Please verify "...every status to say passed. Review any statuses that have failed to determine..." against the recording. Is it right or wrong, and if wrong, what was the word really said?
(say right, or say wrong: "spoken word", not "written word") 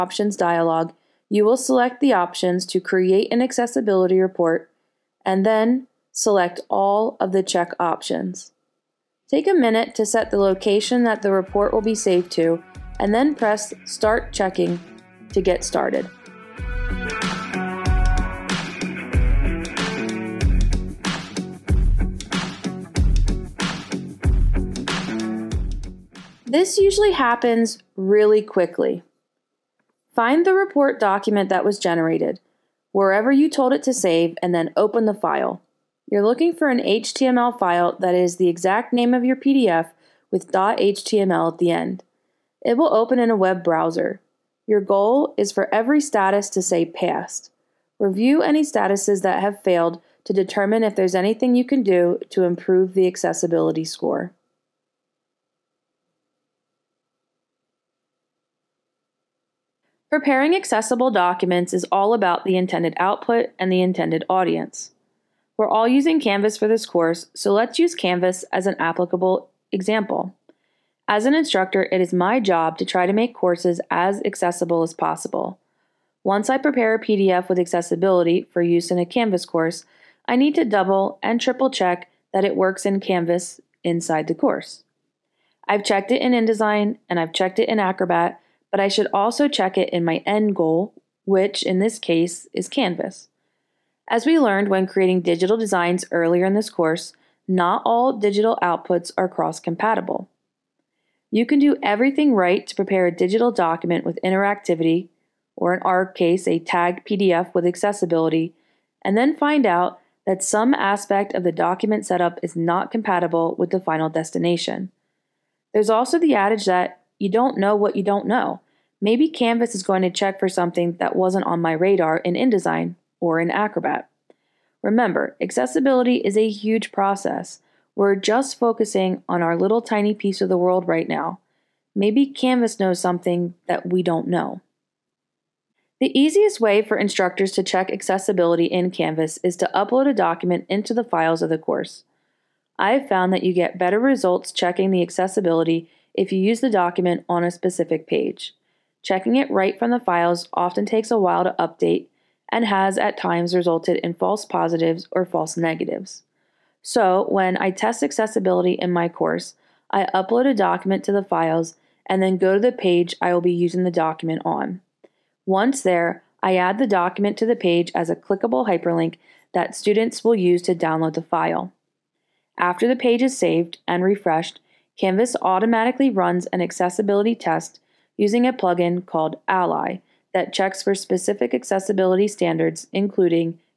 right.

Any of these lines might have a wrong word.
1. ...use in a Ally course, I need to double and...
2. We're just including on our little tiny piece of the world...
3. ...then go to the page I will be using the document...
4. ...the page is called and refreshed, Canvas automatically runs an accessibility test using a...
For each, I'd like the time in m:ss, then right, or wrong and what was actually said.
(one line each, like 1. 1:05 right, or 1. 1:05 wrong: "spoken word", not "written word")
1. 1:18 wrong: "Canvas", not "Ally"
2. 2:07 wrong: "focusing", not "including"
3. 2:42 right
4. 2:52 wrong: "saved", not "called".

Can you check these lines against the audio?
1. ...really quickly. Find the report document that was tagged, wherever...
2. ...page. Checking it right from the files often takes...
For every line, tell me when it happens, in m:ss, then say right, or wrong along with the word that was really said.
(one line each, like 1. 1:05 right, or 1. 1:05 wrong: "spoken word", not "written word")
1. 0:27 wrong: "generated", not "tagged"
2. 2:28 right.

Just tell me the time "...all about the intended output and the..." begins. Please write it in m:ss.
1:01.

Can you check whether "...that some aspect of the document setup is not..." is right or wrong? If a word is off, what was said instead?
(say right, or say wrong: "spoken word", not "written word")
right.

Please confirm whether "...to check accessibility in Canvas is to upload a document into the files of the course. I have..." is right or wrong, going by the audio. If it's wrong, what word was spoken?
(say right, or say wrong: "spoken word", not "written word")
right.